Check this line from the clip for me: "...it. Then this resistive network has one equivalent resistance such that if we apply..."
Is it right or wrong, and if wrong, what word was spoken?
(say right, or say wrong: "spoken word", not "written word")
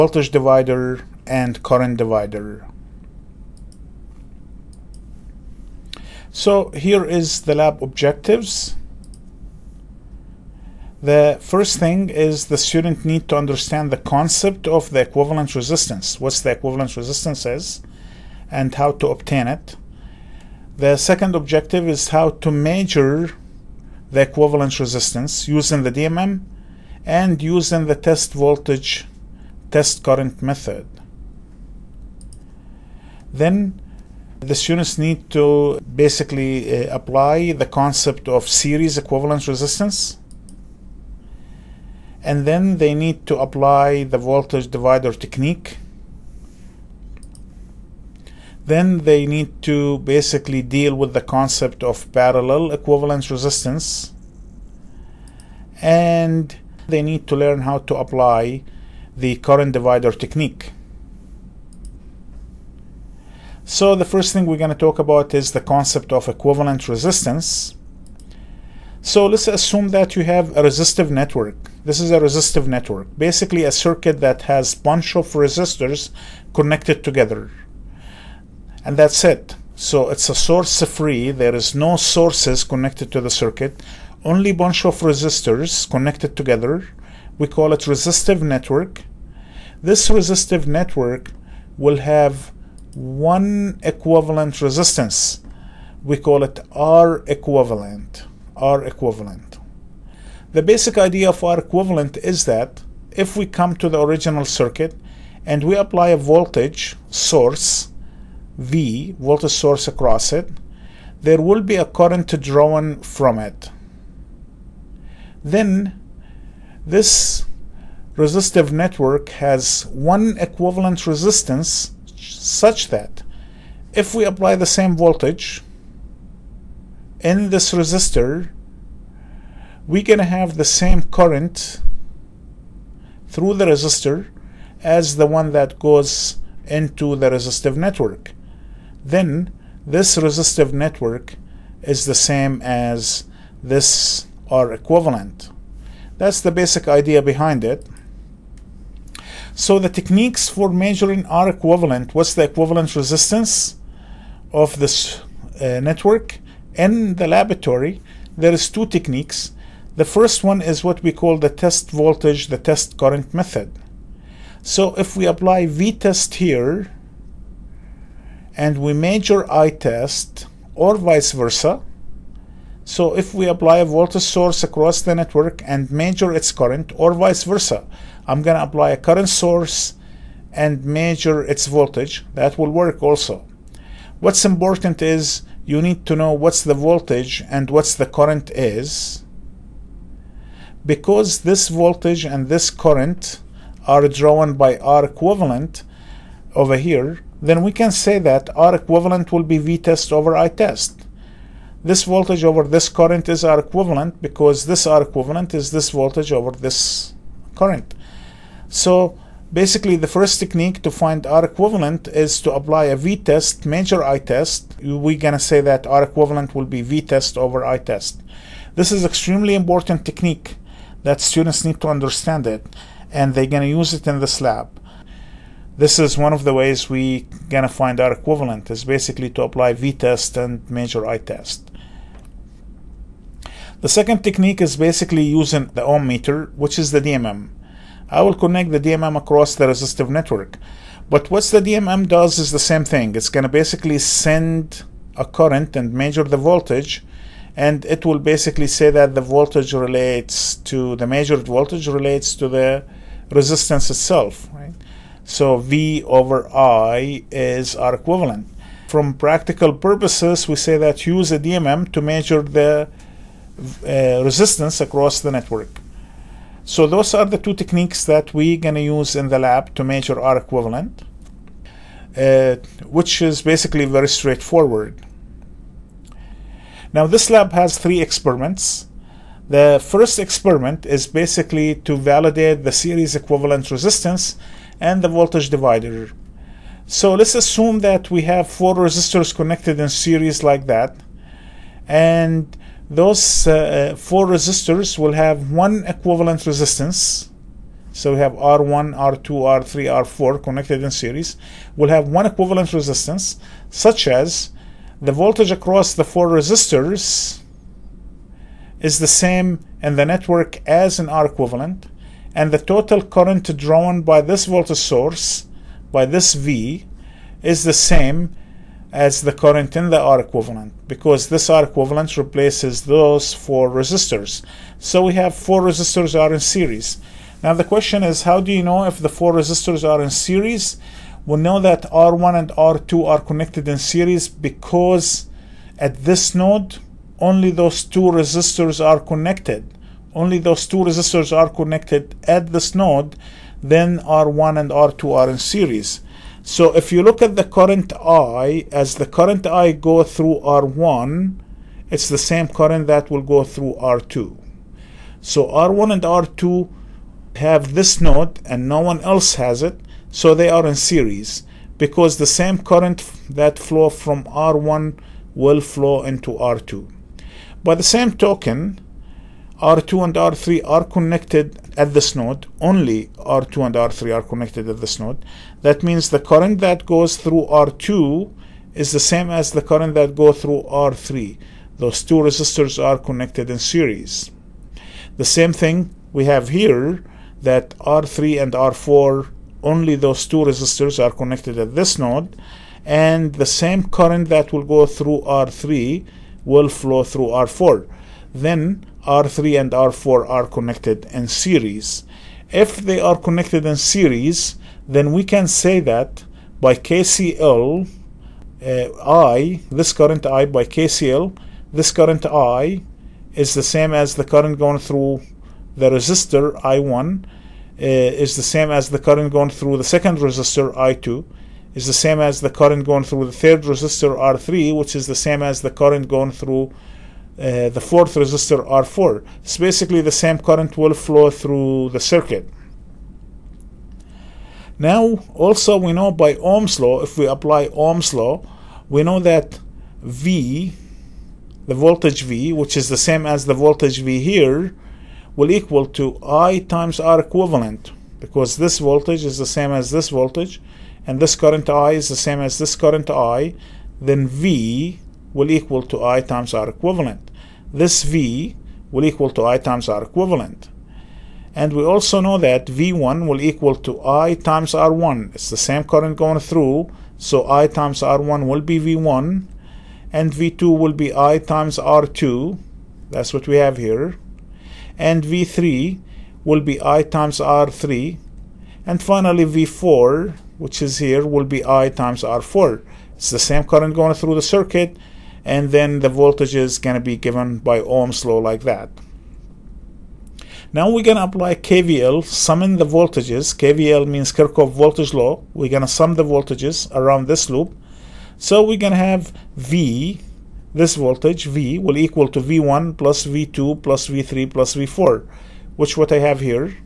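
right.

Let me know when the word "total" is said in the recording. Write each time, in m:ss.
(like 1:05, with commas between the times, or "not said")
5:12.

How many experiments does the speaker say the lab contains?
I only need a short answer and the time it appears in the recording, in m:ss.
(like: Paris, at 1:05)
3, at 4:37.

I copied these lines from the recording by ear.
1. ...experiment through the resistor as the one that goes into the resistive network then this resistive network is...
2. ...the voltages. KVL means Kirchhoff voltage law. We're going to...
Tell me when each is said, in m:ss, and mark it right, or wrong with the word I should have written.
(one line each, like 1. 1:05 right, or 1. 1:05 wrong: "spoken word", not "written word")
1. 2:11 wrong: "current", not "experiment"
2. 8:12 right.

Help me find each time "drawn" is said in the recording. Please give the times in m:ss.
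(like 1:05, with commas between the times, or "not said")
1:52, 3:14, 5:13.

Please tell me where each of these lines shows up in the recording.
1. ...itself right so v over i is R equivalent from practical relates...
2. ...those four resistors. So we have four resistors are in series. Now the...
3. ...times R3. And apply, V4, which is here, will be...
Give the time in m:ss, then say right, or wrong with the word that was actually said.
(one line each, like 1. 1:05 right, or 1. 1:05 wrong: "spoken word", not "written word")
1. 4:13 wrong: "purposes", not "relates"
2. 5:22 right
3. 7:57 wrong: "finally", not "apply".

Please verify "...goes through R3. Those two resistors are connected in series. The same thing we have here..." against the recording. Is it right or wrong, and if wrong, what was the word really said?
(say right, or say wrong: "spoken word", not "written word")
right.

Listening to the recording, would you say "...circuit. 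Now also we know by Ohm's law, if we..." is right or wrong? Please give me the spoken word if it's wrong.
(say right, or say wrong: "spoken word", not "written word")
right.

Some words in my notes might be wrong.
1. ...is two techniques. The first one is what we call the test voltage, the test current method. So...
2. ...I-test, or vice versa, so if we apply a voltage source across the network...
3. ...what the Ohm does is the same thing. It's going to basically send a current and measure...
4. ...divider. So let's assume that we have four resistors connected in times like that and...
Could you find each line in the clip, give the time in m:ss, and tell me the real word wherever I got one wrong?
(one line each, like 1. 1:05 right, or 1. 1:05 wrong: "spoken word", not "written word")
1. 2:38 right
2. 2:49 right
3. 4:01 wrong: "DMM", not "Ohm"
4. 4:45 wrong: "series", not "times".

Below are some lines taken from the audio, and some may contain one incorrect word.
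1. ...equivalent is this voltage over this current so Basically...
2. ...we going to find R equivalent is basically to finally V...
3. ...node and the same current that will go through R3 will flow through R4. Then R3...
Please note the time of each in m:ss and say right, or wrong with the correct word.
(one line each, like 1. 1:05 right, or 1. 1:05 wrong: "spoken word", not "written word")
1. 3:25 right
2. 3:46 wrong: "apply", not "finally"
3. 6:31 right.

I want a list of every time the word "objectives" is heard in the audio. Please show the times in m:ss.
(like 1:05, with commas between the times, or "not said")
0:07, 0:21.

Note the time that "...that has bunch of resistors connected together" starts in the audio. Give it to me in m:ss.
1:14.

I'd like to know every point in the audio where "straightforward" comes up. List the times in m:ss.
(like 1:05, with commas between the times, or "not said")
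4:34.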